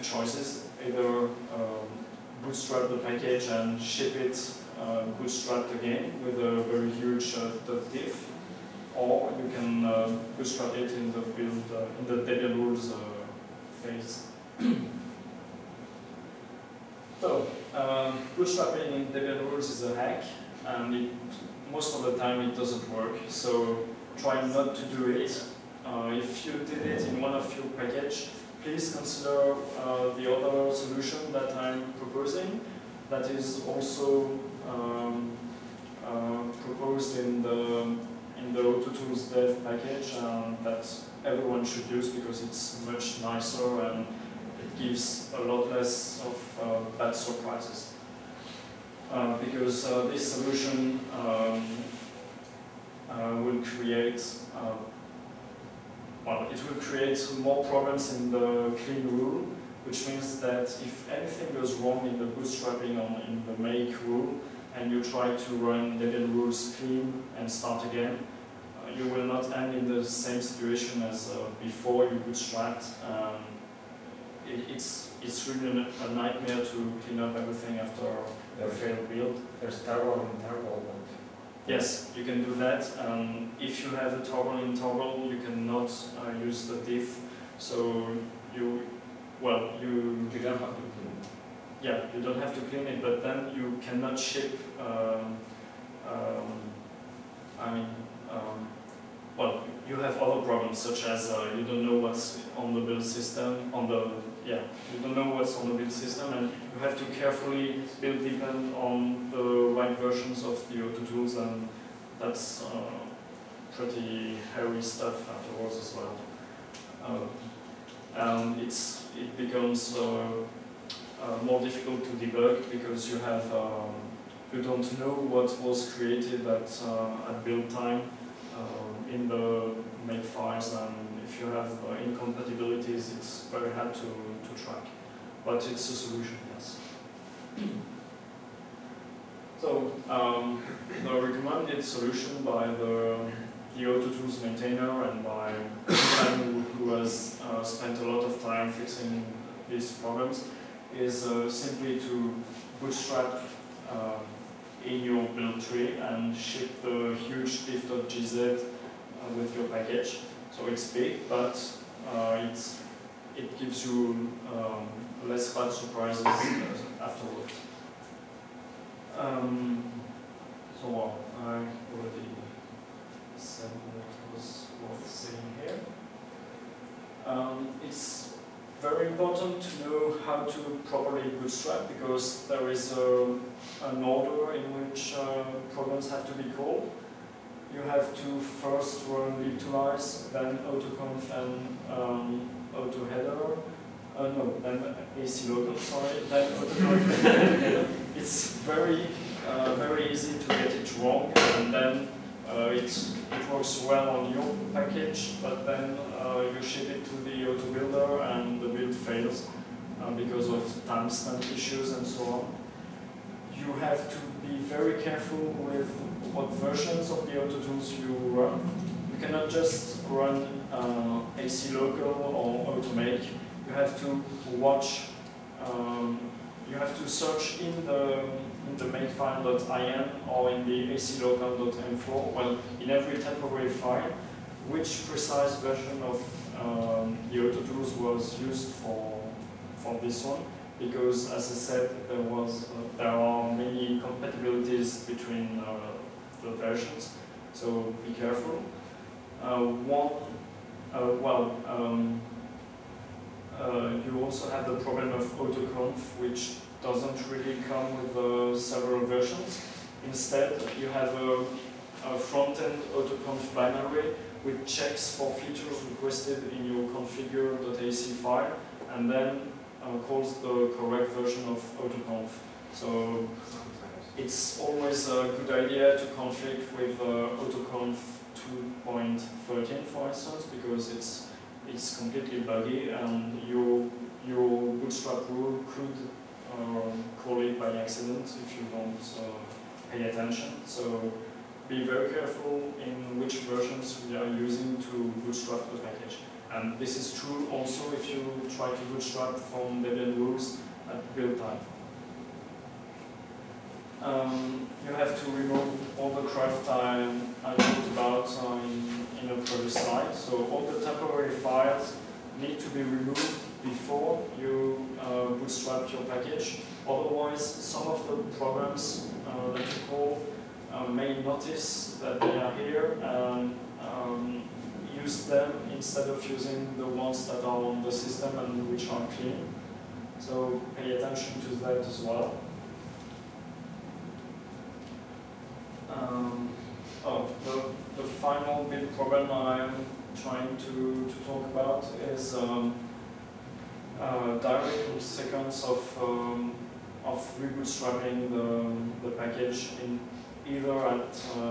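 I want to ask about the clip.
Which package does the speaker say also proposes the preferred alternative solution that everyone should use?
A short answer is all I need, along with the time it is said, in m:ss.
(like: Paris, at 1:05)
AutoTools dev, at 0:38.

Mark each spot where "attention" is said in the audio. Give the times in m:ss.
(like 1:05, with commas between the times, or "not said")
4:50, 5:30.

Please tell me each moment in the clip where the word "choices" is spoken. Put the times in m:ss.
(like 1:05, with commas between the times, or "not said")
0:00.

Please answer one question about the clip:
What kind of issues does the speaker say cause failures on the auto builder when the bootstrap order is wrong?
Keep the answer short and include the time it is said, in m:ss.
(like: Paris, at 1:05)
timestamp issues, at 3:30.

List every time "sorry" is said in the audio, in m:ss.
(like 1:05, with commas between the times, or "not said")
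3:15.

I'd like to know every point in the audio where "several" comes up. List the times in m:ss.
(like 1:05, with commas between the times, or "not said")
4:18.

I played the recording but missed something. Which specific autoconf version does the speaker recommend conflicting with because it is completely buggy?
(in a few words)
2.13.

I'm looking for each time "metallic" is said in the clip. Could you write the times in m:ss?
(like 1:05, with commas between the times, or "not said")
not said.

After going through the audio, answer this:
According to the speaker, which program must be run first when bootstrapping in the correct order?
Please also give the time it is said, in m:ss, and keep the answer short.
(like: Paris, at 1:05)
libtoolize, at 3:09.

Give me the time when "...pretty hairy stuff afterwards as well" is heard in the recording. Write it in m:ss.
1:53.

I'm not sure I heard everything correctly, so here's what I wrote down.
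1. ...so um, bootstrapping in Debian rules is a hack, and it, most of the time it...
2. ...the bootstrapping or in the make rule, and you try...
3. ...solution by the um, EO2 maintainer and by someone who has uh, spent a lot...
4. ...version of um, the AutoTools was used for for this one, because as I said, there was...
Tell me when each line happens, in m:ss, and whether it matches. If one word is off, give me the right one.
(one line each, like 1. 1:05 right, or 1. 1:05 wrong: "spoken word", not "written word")
1. 0:17 right
2. 1:02 right
3. 2:21 right
4. 3:55 right.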